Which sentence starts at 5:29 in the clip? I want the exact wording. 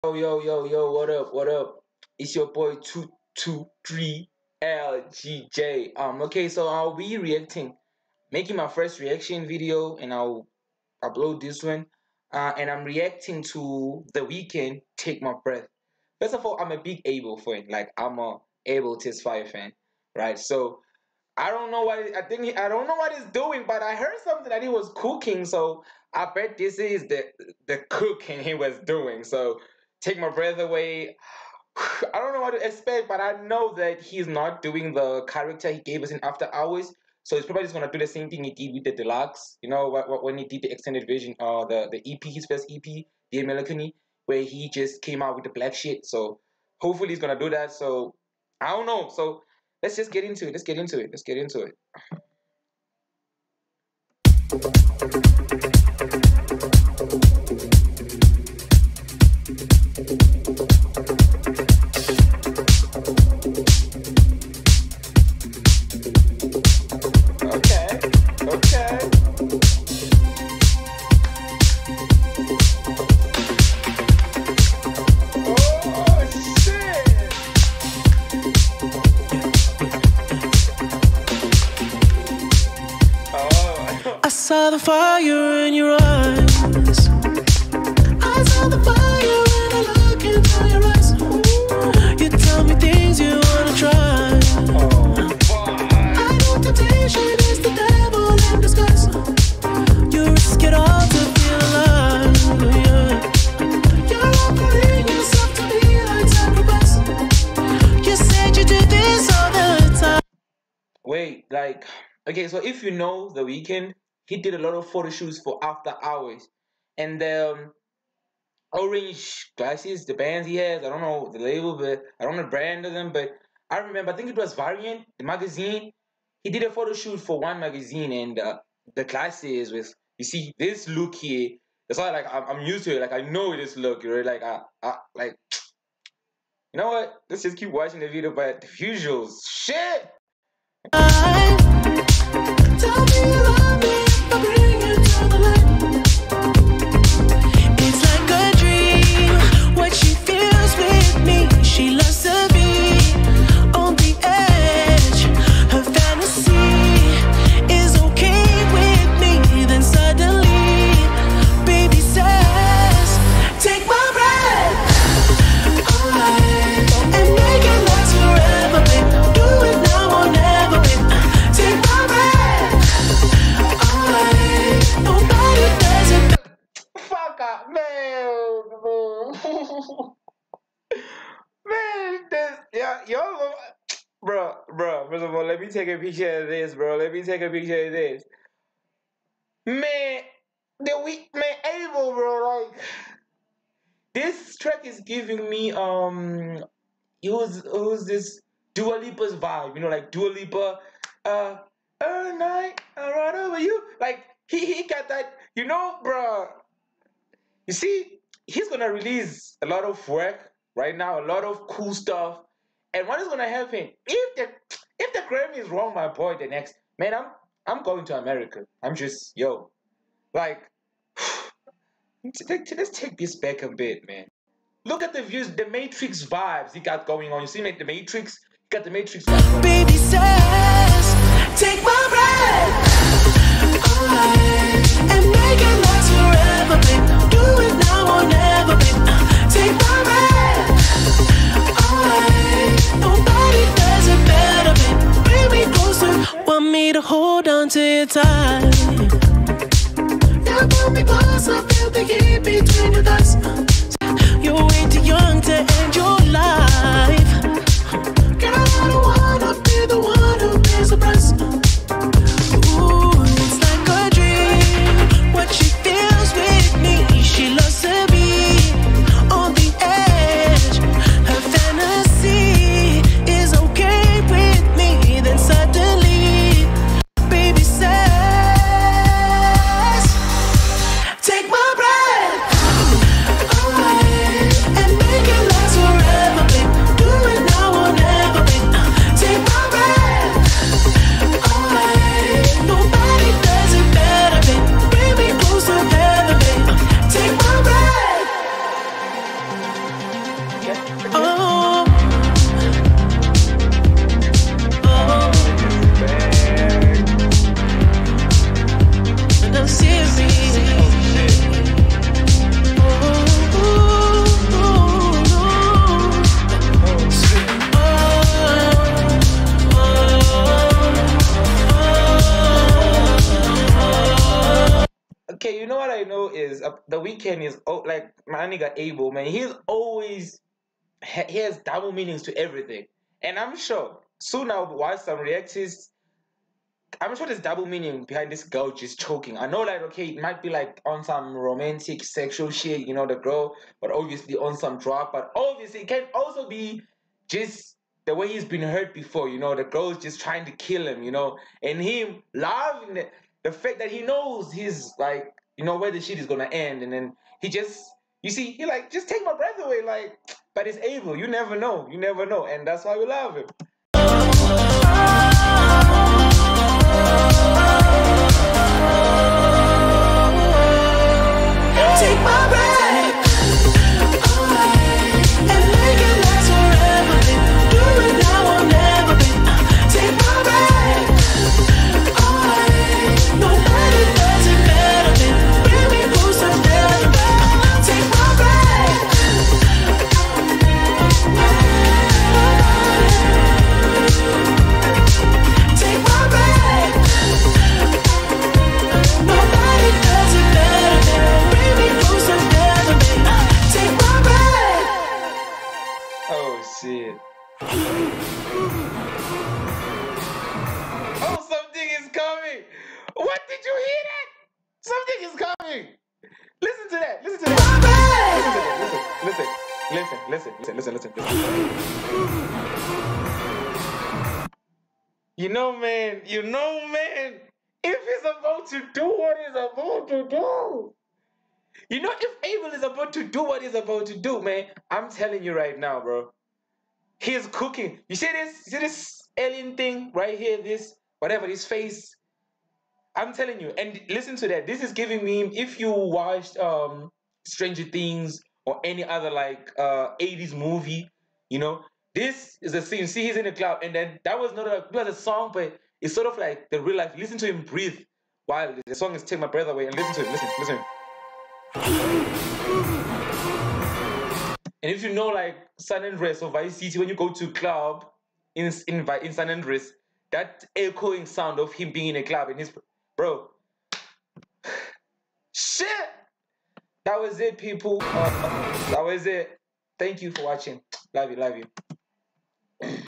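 He's always he has double meanings to everything, and I'm sure soon I'll watch some reactists.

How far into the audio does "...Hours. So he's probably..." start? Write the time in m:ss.
0:36.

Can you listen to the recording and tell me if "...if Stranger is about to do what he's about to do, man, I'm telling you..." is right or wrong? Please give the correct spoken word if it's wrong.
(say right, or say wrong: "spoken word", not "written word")
wrong: "Abel", not "Stranger".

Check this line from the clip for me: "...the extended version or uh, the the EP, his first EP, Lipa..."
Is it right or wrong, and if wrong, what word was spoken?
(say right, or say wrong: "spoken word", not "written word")
wrong: "The", not "Lipa".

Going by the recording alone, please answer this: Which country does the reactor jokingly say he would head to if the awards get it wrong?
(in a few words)
America.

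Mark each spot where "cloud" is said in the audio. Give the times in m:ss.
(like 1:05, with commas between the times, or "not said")
7:33.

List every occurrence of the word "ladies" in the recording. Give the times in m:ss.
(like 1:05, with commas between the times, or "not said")
not said.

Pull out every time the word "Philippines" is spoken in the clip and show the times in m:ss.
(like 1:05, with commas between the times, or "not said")
not said.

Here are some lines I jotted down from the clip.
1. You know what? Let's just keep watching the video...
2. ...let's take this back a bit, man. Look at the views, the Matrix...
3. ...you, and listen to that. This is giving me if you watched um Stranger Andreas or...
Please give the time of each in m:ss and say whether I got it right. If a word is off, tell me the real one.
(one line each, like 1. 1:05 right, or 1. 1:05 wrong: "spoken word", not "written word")
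1. 2:16 right
2. 3:42 right
3. 7:23 wrong: "Things", not "Andreas".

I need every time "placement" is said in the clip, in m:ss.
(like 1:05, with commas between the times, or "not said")
not said.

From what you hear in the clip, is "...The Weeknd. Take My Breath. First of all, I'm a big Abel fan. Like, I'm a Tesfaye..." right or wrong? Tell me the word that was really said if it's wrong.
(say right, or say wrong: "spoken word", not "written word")
wrong: "Abel", not "Tesfaye".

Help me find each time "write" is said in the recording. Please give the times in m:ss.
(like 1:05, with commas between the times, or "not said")
not said.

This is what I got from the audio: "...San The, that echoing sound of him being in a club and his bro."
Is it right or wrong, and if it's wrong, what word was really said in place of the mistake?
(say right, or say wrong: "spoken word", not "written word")
wrong: "Andreas", not "The".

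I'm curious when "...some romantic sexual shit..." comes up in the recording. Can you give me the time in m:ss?
5:41.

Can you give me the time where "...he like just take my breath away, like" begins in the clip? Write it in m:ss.
5:58.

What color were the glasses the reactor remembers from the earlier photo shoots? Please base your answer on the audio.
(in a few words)
Orange.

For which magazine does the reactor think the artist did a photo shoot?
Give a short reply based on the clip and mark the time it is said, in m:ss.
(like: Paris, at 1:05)
Variant, at 2:04.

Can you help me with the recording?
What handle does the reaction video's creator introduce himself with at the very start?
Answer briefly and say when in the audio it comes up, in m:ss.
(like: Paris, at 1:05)
223LGJ, at 0:04.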